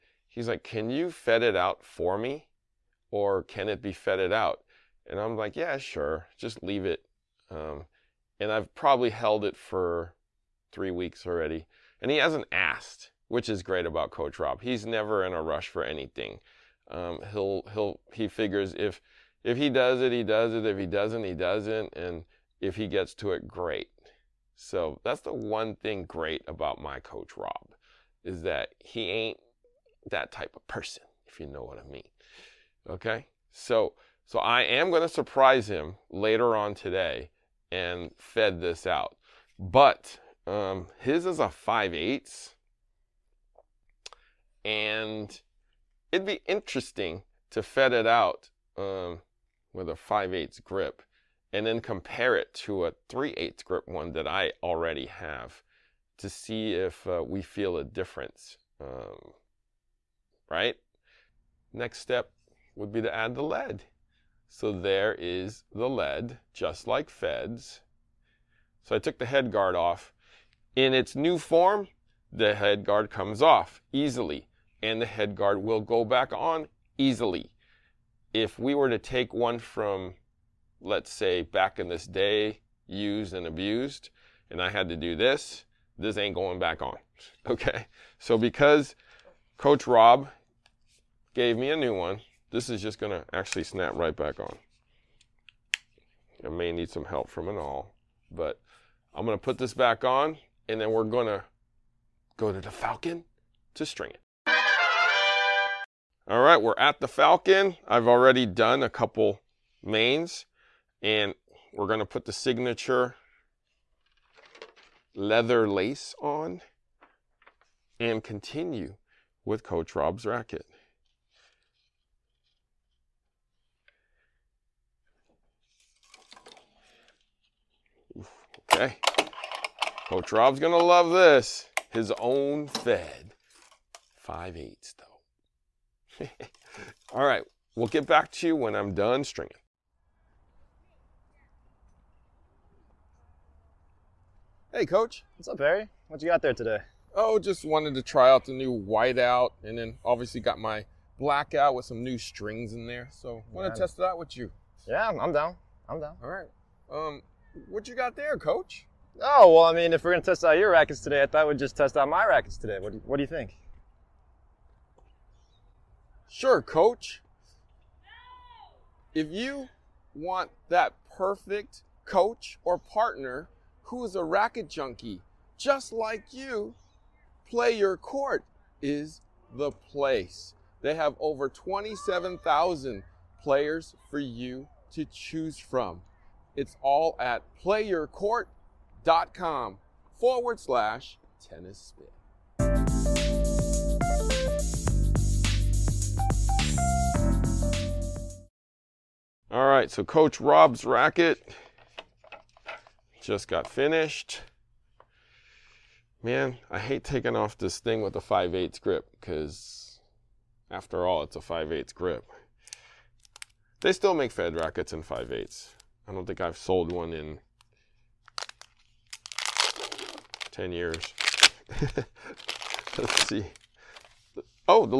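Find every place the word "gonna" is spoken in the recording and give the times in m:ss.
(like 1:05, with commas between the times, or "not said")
1:51, 2:10, 2:40.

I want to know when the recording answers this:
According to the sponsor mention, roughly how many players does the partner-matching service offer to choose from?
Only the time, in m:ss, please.
3:01.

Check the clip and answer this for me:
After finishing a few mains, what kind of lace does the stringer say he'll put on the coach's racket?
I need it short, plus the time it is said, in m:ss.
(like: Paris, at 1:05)
signature leather lace, at 1:52.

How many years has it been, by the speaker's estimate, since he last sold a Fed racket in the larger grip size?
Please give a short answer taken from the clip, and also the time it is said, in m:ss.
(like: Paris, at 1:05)
10, at 3:40.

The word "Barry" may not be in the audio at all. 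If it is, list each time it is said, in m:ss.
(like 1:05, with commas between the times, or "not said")
2:25.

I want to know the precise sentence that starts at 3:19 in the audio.
All right, so Coach Rob's racket just got finished.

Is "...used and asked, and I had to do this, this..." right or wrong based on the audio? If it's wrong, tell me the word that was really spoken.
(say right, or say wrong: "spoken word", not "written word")
wrong: "abused", not "asked".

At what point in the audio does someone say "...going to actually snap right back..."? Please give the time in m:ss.
1:32.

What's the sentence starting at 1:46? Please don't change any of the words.
All right, we're at the Falcon.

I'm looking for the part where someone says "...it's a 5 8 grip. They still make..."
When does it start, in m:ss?
3:31.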